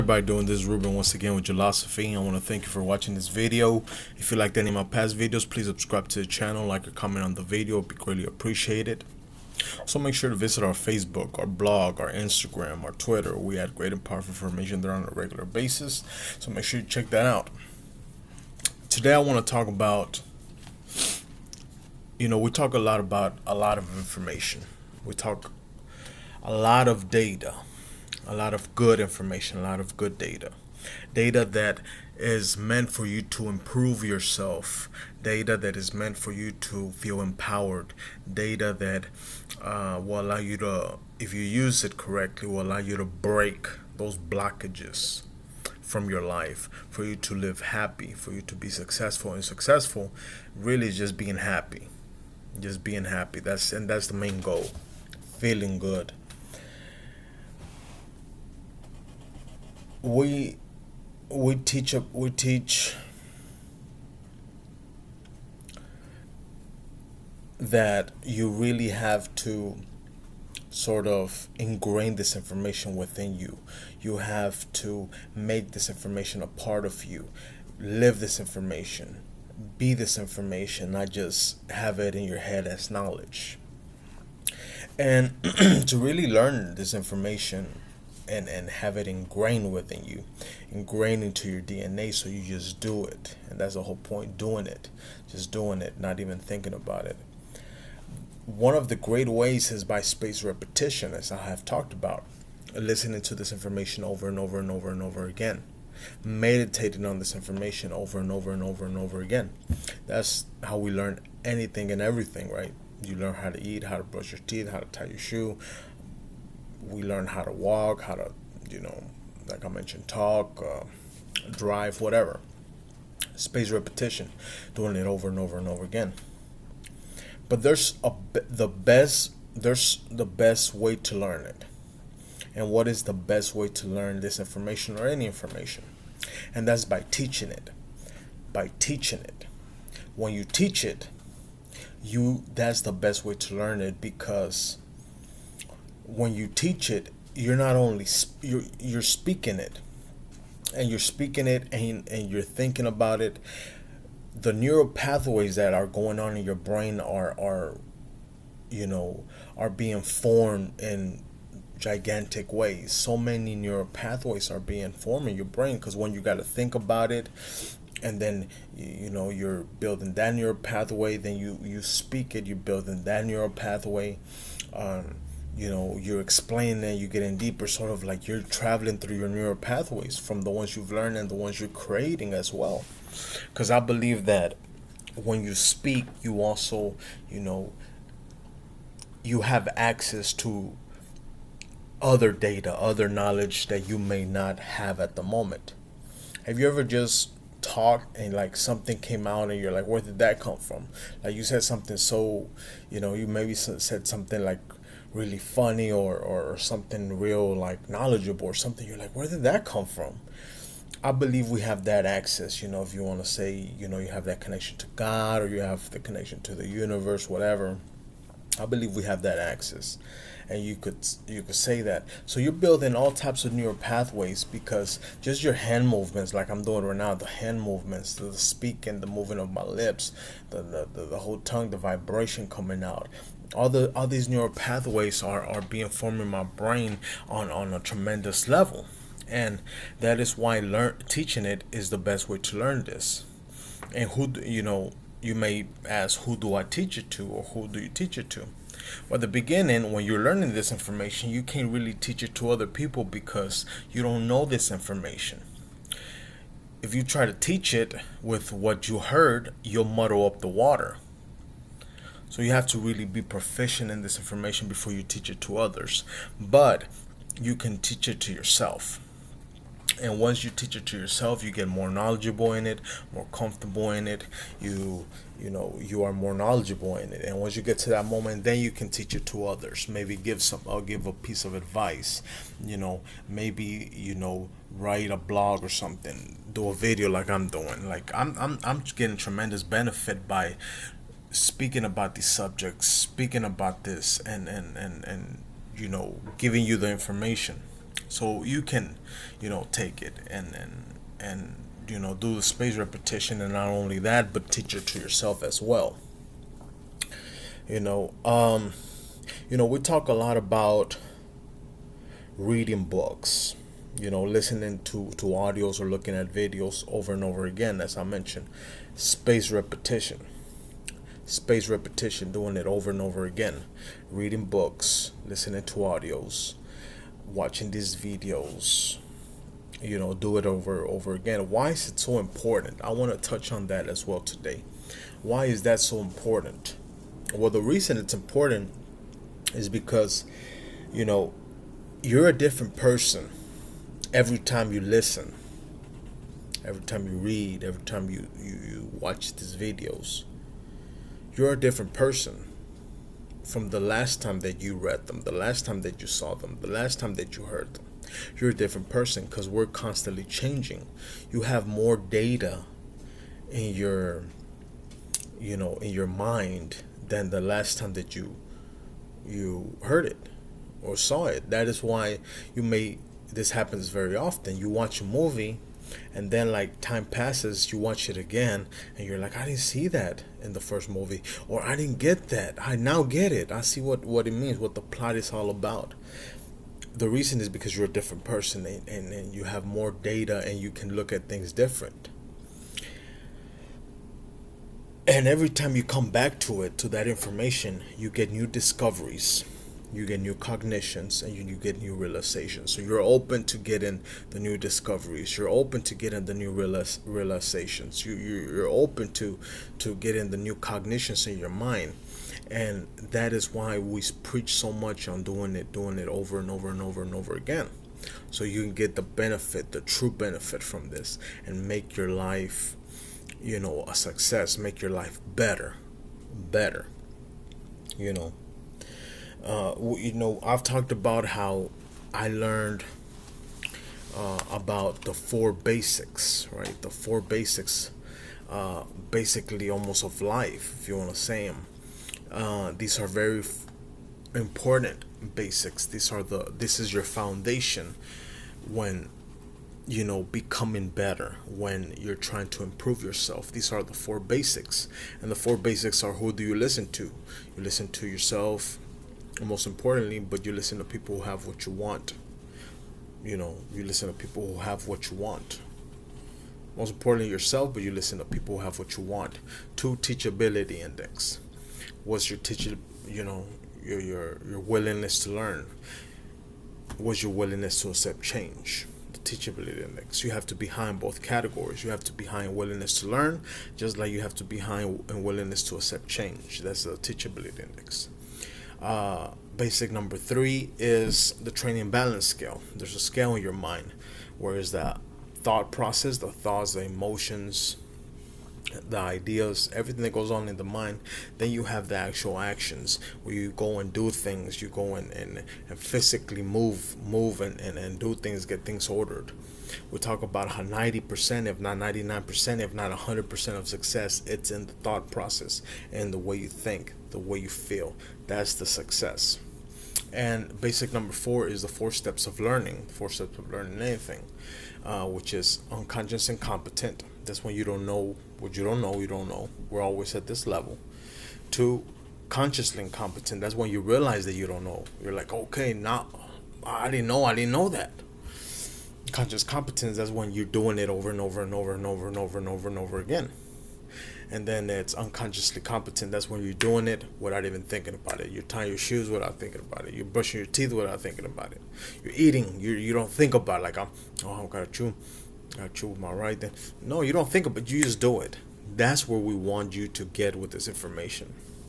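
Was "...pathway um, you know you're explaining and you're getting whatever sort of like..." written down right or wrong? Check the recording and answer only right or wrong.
wrong.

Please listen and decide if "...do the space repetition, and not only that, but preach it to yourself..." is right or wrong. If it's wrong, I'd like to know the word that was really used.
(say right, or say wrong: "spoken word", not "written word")
wrong: "teach", not "preach".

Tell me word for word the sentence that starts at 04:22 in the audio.
So you have to really be proficient in this information before you teach it to others.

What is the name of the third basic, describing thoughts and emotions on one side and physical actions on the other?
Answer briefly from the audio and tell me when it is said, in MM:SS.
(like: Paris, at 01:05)
Training balance scale, at 08:11.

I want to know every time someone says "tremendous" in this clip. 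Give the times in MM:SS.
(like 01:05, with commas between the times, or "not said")
03:57, 04:49.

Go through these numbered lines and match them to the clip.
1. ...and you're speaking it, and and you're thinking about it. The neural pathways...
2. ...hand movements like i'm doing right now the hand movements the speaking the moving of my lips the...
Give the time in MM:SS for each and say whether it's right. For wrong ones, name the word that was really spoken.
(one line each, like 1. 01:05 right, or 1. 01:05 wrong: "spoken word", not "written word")
1. 02:30 right
2. 03:45 right.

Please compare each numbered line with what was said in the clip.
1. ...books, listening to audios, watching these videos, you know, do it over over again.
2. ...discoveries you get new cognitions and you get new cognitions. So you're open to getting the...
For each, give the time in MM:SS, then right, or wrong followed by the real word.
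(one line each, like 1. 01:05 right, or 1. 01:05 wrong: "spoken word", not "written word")
1. 05:24 right
2. 06:38 wrong: "realizations", not "cognitions".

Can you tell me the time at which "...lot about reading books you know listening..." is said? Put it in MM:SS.
05:10.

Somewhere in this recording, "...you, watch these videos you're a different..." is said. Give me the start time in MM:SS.
05:48.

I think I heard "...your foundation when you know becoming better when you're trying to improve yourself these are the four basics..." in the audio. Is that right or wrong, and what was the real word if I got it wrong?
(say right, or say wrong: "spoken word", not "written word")
right.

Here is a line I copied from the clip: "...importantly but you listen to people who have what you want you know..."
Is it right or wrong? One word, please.
right.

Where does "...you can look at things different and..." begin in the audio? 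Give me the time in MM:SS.
06:30.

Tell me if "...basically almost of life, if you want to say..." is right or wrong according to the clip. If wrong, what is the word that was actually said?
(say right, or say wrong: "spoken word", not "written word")
right.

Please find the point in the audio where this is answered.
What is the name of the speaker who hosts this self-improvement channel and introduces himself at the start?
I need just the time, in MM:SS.
00:00.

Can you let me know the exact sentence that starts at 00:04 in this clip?
If you liked any of my past videos, please subscribe to the channel, like or comment on the video.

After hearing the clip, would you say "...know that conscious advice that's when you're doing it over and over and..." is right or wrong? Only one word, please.
wrong.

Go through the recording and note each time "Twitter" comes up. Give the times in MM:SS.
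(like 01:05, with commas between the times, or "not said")
00:12.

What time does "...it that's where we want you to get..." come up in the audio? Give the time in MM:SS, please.
09:18.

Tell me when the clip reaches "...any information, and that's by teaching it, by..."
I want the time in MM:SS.
02:15.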